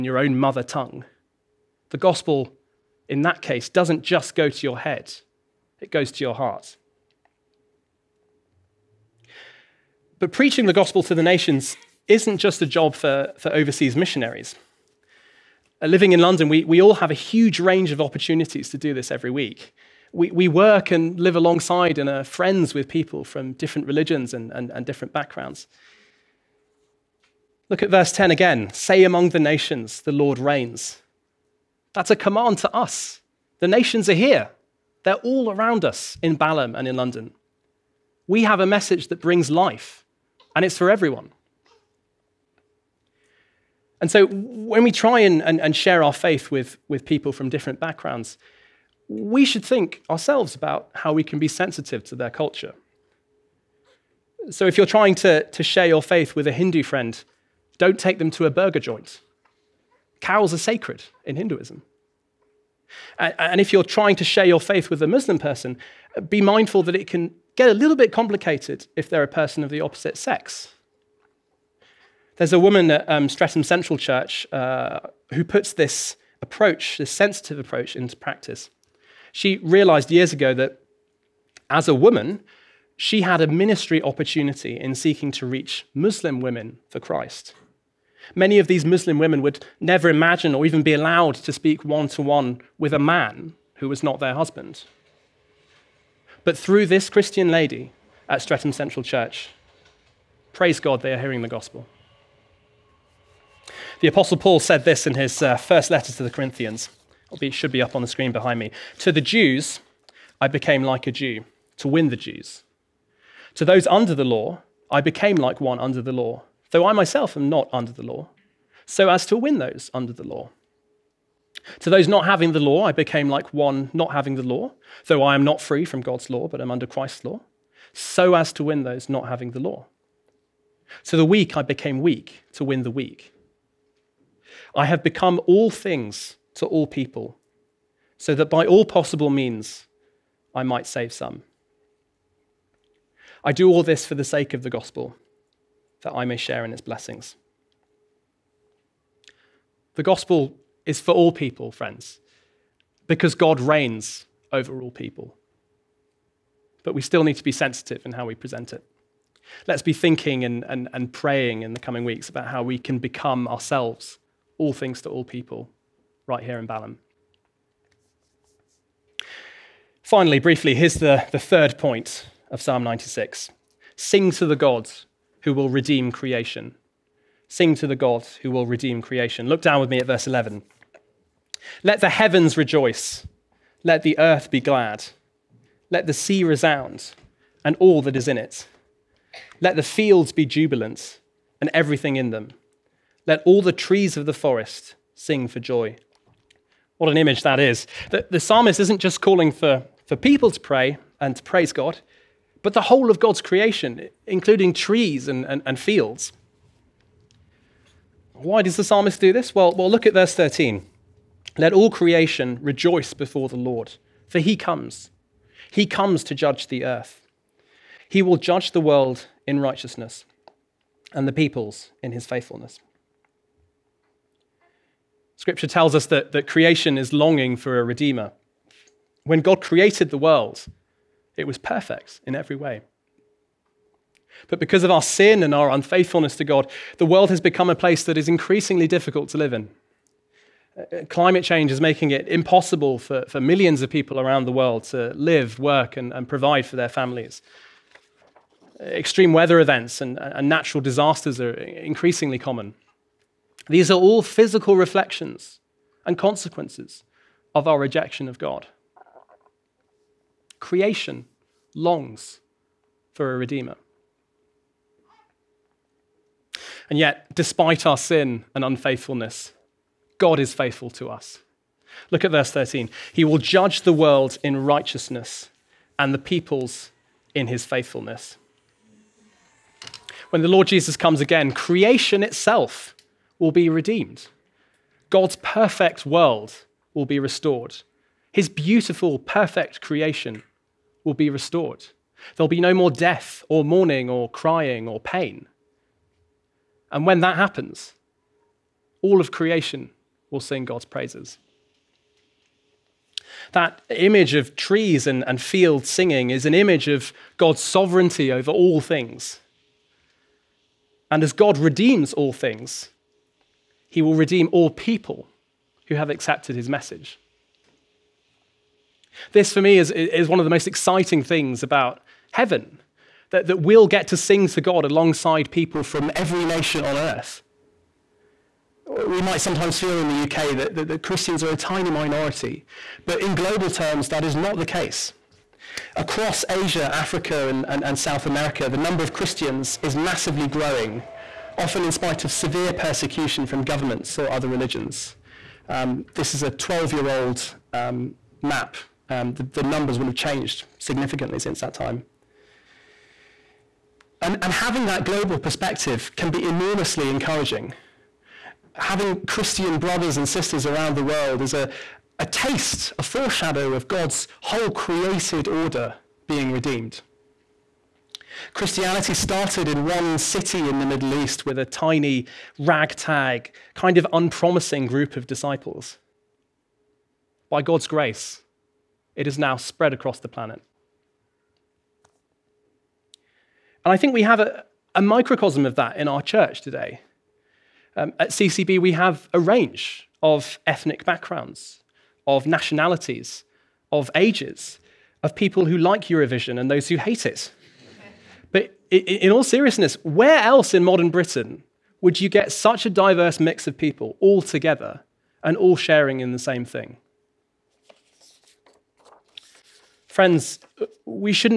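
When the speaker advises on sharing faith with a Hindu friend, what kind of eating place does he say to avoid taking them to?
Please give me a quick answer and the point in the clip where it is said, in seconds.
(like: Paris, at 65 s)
A burger joint, at 58 s.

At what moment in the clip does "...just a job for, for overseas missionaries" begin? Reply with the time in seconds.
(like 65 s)
12 s.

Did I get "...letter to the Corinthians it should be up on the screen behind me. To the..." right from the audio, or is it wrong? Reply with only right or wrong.
right.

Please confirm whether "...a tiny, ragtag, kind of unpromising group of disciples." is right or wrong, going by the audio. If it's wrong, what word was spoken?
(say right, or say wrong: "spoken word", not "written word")
right.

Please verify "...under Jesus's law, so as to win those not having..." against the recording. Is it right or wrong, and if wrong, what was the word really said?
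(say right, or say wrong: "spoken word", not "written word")
wrong: "Christ", not "Jesus".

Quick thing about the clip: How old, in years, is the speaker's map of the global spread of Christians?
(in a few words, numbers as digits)
12 years.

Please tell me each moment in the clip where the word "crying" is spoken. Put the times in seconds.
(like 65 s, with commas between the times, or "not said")
294 s.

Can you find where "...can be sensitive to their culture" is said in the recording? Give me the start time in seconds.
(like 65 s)
51 s.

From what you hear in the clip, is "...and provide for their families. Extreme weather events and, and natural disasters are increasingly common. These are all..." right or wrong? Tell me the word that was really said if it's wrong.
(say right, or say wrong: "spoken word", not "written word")
right.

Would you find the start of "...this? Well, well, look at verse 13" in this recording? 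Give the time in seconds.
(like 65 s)
209 s.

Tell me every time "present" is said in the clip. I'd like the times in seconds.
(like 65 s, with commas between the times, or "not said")
158 s.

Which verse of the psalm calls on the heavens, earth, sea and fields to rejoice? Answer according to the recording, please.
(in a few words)
Verse 11.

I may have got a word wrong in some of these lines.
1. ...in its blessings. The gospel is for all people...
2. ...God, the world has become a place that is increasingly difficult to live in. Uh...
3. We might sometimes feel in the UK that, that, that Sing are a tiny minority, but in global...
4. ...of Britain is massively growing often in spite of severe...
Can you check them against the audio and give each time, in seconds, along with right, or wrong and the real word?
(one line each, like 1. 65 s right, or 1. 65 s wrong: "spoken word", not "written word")
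1. 146 s right
2. 236 s right
3. 329 s wrong: "Christians", not "Sing"
4. 339 s wrong: "Christians", not "Britain".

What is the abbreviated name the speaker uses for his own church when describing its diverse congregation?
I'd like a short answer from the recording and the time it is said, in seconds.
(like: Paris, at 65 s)
CCB, at 388 s.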